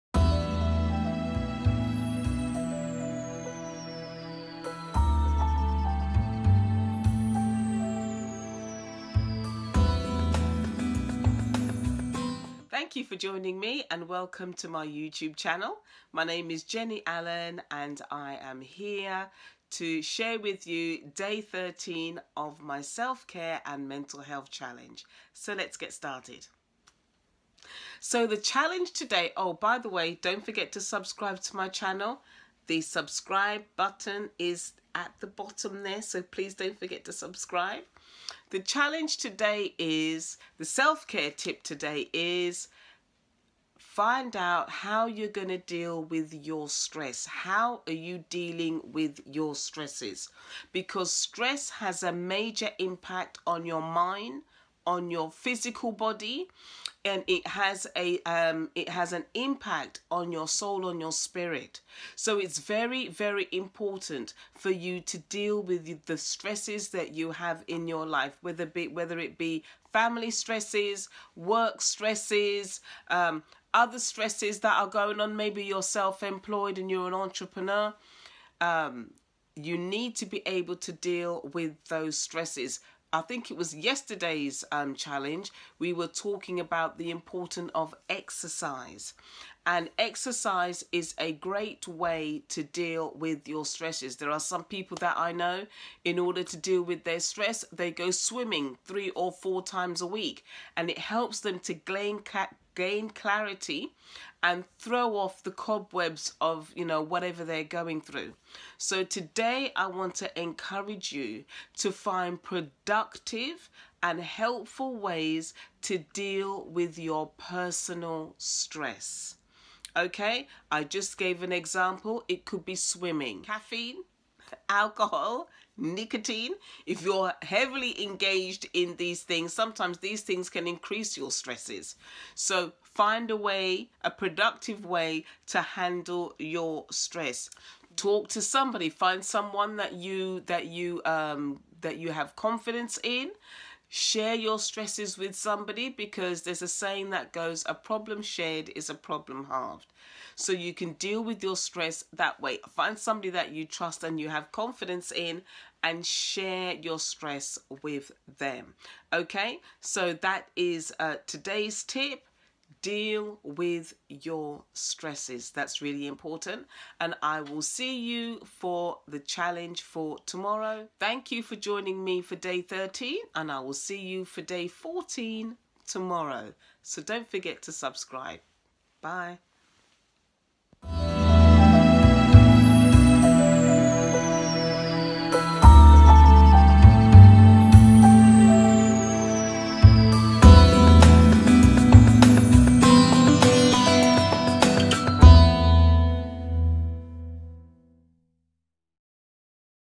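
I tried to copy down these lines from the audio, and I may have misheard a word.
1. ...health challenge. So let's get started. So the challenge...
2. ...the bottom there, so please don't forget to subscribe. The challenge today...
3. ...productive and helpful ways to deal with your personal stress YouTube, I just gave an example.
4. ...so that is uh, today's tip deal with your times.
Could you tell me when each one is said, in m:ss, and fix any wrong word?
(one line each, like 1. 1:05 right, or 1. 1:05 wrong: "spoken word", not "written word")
1. 0:24 right
2. 0:35 right
3. 1:52 wrong: "Okay", not "YouTube"
4. 2:39 wrong: "stresses", not "times".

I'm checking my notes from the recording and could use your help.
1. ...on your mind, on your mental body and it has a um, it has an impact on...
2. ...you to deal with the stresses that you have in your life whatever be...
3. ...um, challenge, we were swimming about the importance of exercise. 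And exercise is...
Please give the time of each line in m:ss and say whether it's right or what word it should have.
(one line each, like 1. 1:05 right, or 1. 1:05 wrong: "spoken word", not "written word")
1. 0:53 wrong: "physical", not "mental"
2. 1:04 wrong: "whether", not "whatever"
3. 1:24 wrong: "talking", not "swimming".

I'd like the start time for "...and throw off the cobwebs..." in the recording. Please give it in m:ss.
1:44.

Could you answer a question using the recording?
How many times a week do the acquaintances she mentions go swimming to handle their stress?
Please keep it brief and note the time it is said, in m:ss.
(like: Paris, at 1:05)
3 or 4, at 1:38.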